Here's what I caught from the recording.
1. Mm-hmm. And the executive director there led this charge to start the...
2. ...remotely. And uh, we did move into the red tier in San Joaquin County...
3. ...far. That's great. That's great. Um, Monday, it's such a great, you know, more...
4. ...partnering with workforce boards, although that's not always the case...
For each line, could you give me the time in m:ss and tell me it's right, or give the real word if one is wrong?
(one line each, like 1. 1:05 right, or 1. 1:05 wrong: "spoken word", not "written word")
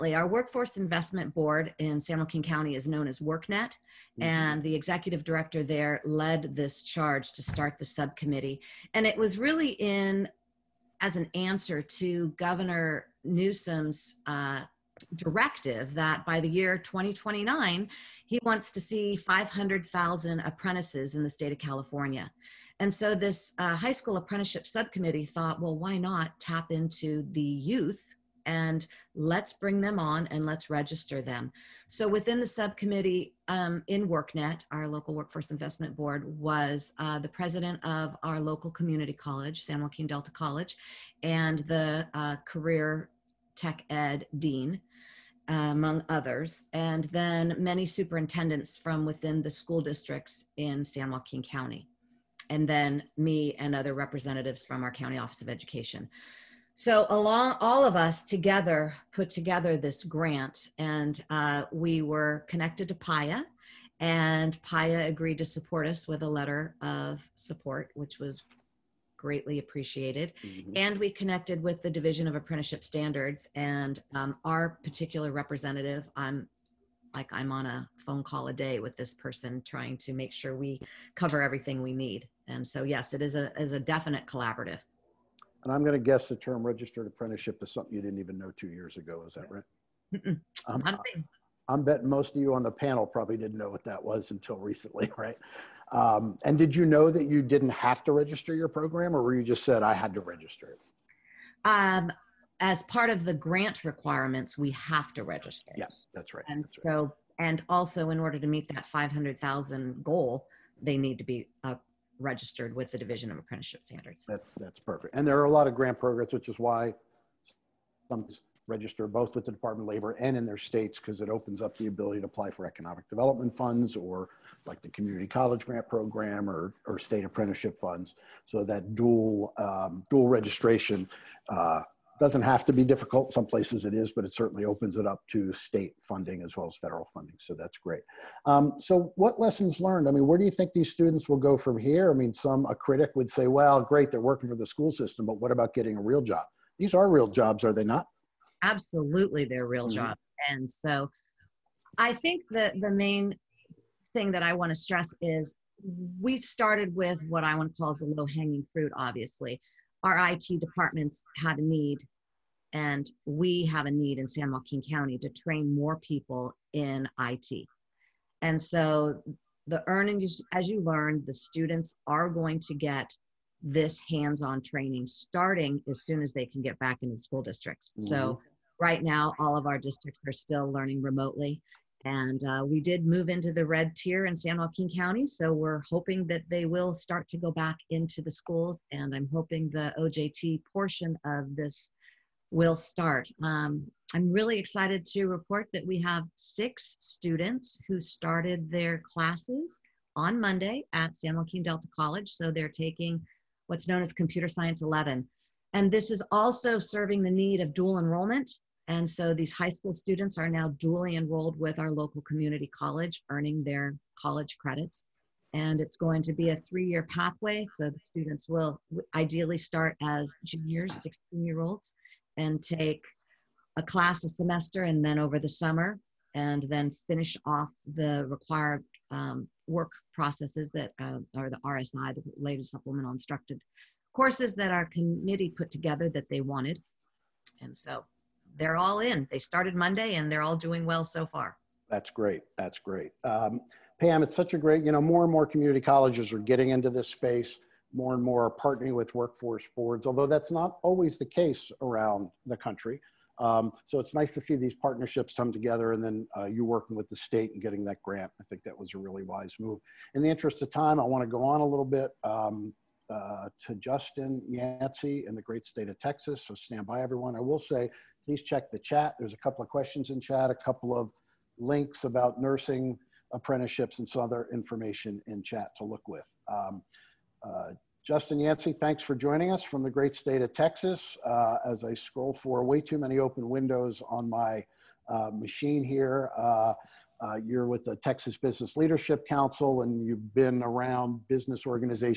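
1. 0:03 right
2. 3:01 right
3. 4:01 wrong: "Pam", not "Monday"
4. 4:08 right.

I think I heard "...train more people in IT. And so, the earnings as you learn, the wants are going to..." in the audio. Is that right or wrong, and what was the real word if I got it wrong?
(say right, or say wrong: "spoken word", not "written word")
wrong: "students", not "wants".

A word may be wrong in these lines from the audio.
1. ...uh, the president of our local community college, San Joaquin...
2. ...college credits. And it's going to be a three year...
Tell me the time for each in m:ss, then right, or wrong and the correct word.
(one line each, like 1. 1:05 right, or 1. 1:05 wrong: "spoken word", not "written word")
1. 0:36 right
2. 3:34 right.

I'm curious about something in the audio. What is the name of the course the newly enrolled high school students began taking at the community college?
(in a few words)
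Computer Science 11.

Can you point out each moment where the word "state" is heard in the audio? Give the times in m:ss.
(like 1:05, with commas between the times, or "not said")
0:21, 2:00, 2:06, 2:15, 4:17, 4:25, 4:40.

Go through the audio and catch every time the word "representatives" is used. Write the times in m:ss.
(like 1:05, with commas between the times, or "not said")
0:53, 1:15.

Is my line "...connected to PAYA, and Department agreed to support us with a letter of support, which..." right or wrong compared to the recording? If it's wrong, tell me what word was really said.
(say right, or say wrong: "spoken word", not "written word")
wrong: "PAYA", not "Department".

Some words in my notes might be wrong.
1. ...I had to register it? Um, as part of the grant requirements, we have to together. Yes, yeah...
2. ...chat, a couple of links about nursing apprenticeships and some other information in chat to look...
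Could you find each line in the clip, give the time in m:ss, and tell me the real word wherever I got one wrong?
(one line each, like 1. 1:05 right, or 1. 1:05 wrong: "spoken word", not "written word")
1. 1:39 wrong: "register", not "together"
2. 4:30 right.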